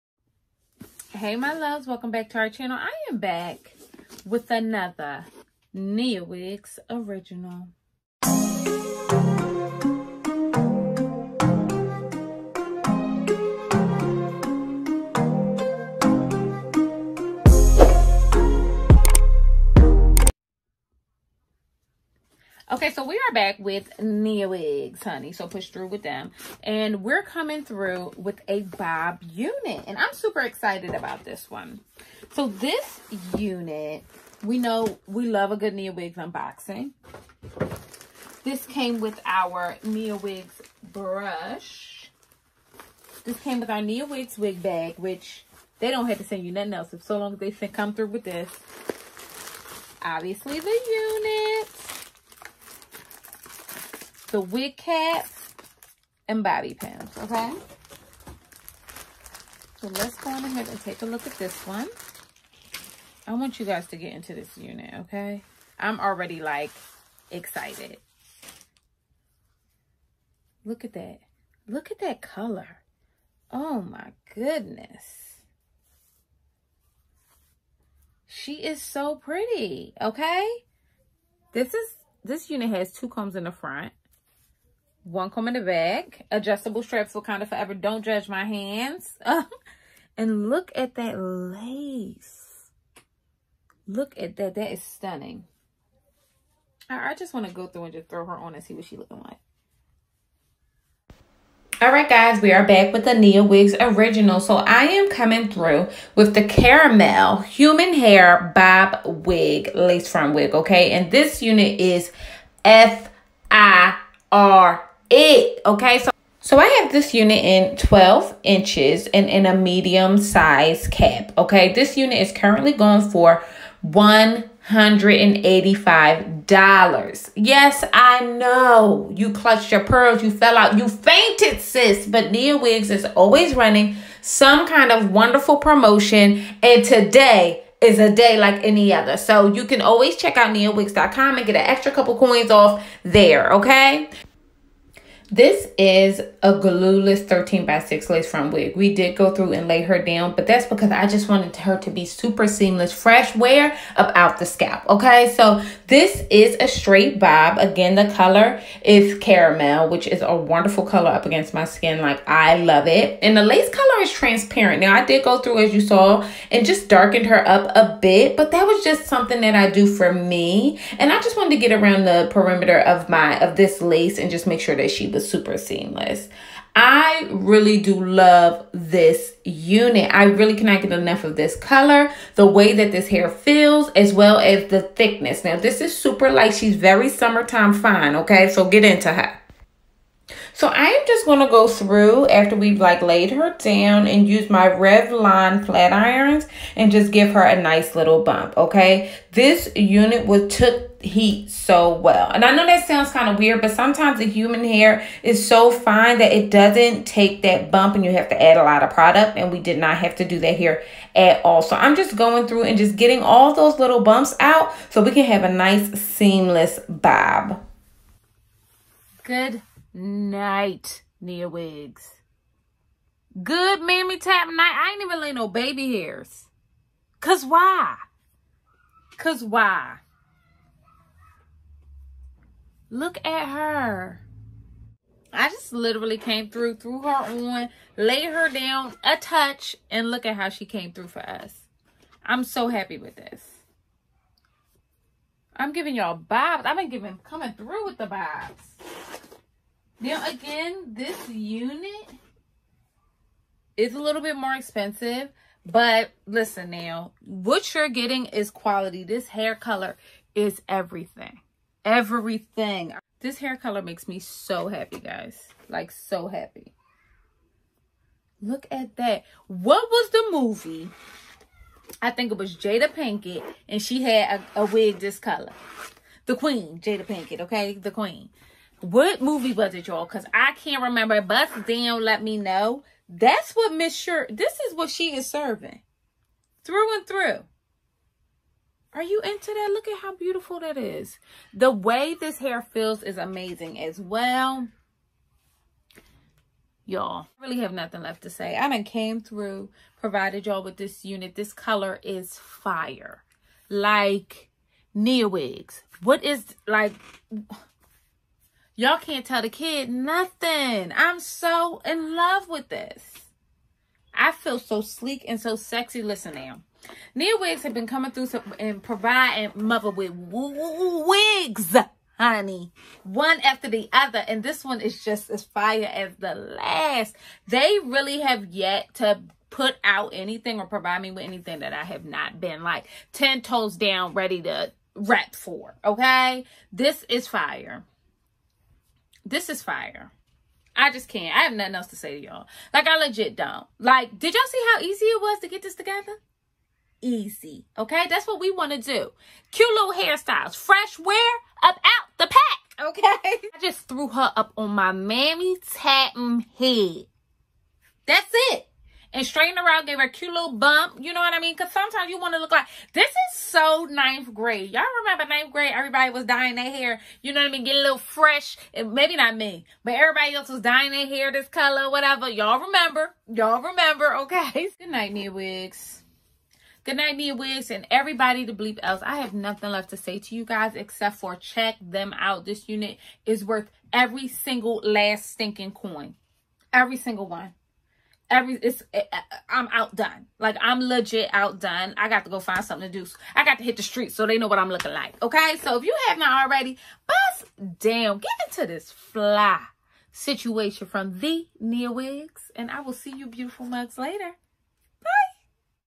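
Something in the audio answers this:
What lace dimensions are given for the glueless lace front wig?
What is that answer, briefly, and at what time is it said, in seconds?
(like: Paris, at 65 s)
13 by 6, at 147 s.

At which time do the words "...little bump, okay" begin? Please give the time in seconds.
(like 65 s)
197 s.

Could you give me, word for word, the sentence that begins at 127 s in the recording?
Yes, I know you clutched your pearls, you fell out, you fainted, sis.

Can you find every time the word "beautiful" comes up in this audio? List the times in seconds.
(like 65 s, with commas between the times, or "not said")
290 s, 403 s.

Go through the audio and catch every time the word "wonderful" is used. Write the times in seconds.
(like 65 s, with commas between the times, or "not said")
135 s, 160 s.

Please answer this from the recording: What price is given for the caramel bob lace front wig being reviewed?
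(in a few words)
$185.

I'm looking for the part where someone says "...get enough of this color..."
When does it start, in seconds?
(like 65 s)
180 s.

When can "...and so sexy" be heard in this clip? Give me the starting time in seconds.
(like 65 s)
315 s.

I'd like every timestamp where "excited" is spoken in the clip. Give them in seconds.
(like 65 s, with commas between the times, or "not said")
30 s, 67 s.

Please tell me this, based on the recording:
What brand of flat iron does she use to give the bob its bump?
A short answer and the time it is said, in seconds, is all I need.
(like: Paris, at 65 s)
Revlon, at 194 s.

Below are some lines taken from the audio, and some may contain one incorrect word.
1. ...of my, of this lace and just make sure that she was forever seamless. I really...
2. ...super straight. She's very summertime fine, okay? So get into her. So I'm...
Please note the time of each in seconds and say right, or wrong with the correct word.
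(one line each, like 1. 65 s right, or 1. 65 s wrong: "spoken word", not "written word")
1. 172 s wrong: "super", not "forever"
2. 185 s wrong: "light", not "straight".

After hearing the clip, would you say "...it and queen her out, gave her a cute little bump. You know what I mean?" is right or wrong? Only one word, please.
wrong.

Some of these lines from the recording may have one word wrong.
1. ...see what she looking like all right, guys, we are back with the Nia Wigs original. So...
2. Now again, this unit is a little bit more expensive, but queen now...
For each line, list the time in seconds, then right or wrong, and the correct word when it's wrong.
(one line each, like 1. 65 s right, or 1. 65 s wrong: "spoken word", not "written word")
1. 98 s right
2. 250 s wrong: "listen", not "queen".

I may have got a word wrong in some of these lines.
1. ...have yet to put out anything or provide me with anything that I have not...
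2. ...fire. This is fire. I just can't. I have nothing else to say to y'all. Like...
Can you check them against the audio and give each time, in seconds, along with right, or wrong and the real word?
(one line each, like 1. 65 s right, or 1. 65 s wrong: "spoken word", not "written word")
1. 328 s right
2. 337 s right.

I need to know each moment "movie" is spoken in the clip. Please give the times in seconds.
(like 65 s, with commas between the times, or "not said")
270 s, 279 s.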